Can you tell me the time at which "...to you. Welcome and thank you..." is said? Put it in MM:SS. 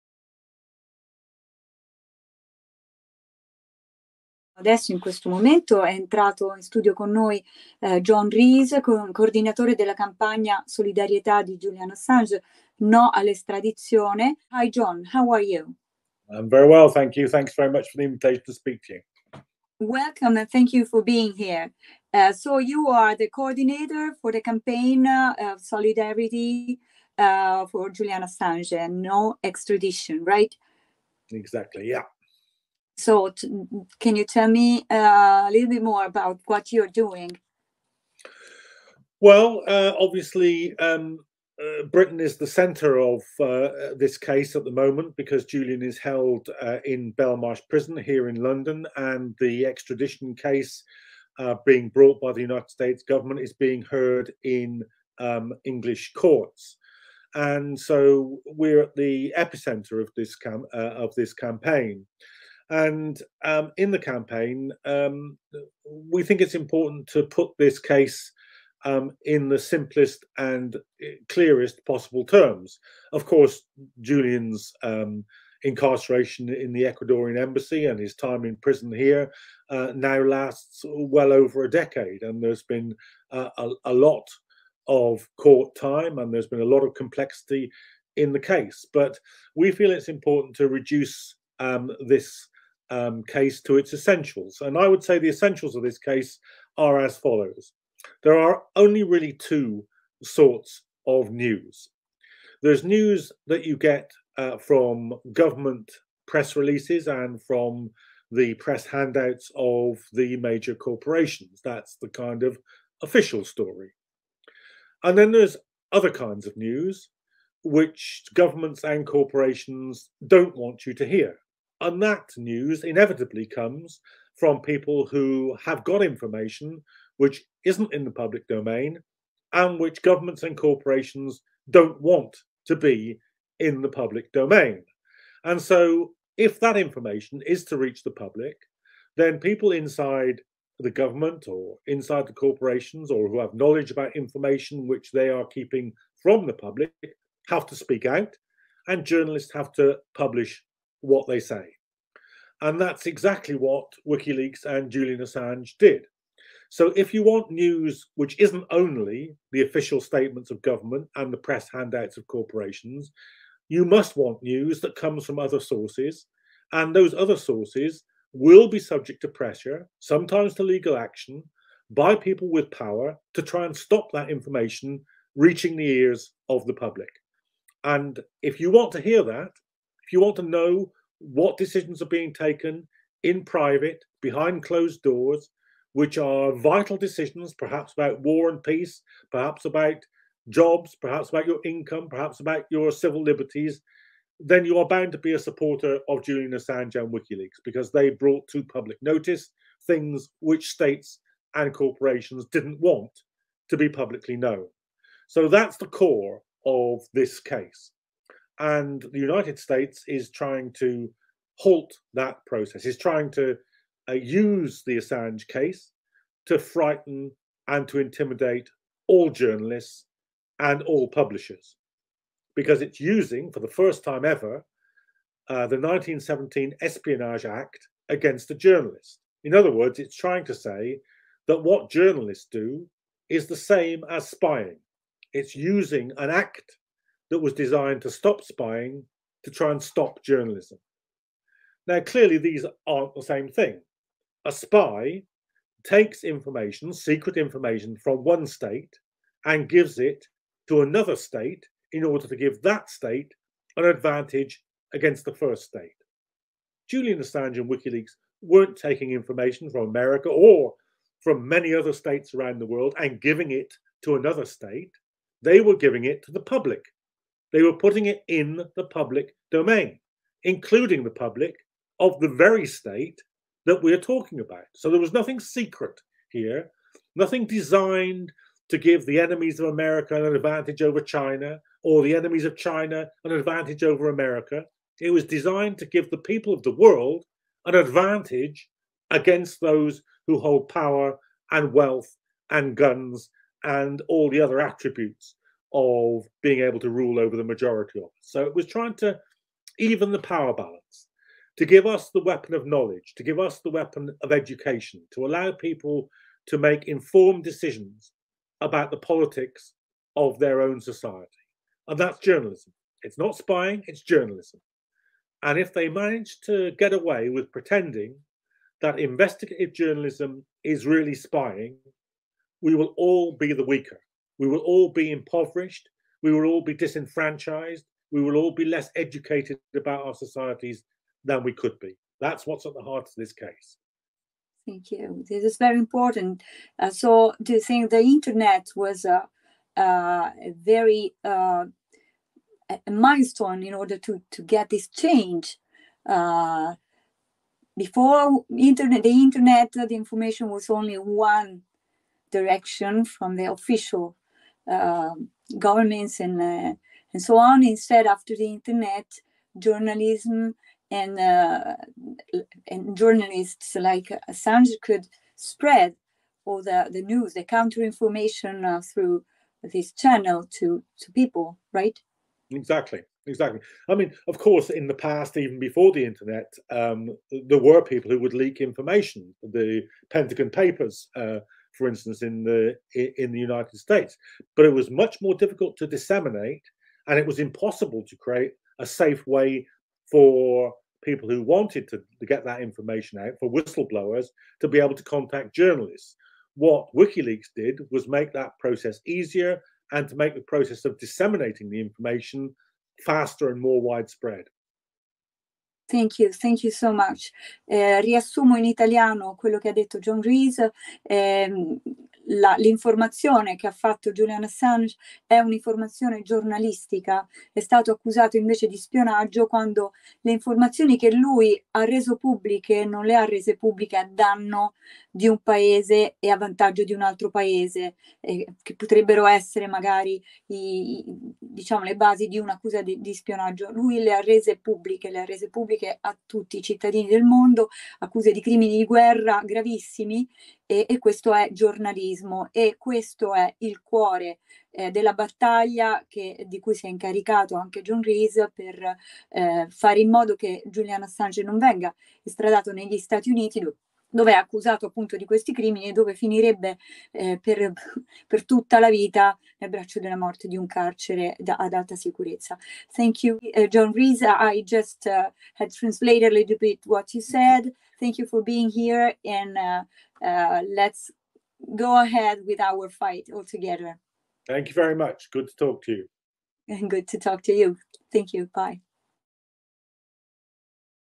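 00:18.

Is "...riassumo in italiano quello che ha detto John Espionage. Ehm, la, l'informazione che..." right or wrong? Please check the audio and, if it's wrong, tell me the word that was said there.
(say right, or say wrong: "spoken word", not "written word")
wrong: "Rees", not "Espionage".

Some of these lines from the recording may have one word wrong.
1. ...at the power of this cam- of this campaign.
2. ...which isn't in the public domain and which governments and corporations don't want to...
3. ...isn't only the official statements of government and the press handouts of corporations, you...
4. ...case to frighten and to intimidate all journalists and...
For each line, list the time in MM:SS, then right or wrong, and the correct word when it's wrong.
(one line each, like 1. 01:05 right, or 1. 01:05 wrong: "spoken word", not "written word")
1. 00:58 wrong: "epicenter", not "power"
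2. 02:07 right
3. 02:38 right
4. 03:35 right.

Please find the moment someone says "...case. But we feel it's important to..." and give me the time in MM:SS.
01:28.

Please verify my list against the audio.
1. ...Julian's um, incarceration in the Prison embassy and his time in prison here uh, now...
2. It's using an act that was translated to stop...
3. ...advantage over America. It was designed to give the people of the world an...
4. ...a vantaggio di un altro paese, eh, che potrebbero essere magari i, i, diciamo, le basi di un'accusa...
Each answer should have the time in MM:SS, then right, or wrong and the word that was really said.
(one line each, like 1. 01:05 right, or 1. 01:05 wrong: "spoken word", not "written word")
1. 01:13 wrong: "Ecuadorian", not "Prison"
2. 03:55 wrong: "designed", not "translated"
3. 04:43 right
4. 07:06 right.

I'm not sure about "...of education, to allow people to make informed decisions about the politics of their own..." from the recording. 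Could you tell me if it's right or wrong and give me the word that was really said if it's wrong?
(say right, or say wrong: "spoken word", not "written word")
right.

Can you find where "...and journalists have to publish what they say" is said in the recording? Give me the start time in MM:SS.
02:28.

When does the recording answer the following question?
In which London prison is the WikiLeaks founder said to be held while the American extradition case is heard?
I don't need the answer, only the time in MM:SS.
00:47.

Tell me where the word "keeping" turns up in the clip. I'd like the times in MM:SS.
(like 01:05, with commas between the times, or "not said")
02:25.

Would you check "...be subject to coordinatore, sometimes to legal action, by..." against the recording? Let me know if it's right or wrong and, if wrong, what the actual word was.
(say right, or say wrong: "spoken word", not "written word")
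wrong: "pressure", not "coordinatore".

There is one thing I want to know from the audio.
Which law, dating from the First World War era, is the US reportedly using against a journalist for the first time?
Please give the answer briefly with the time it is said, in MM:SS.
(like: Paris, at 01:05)
1917 Espionage Act, at 03:45.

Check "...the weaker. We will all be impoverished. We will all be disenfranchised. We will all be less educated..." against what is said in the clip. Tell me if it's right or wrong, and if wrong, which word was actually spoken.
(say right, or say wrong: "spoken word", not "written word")
right.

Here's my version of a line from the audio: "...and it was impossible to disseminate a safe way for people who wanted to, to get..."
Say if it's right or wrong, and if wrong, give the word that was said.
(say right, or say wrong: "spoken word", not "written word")
wrong: "create", not "disseminate".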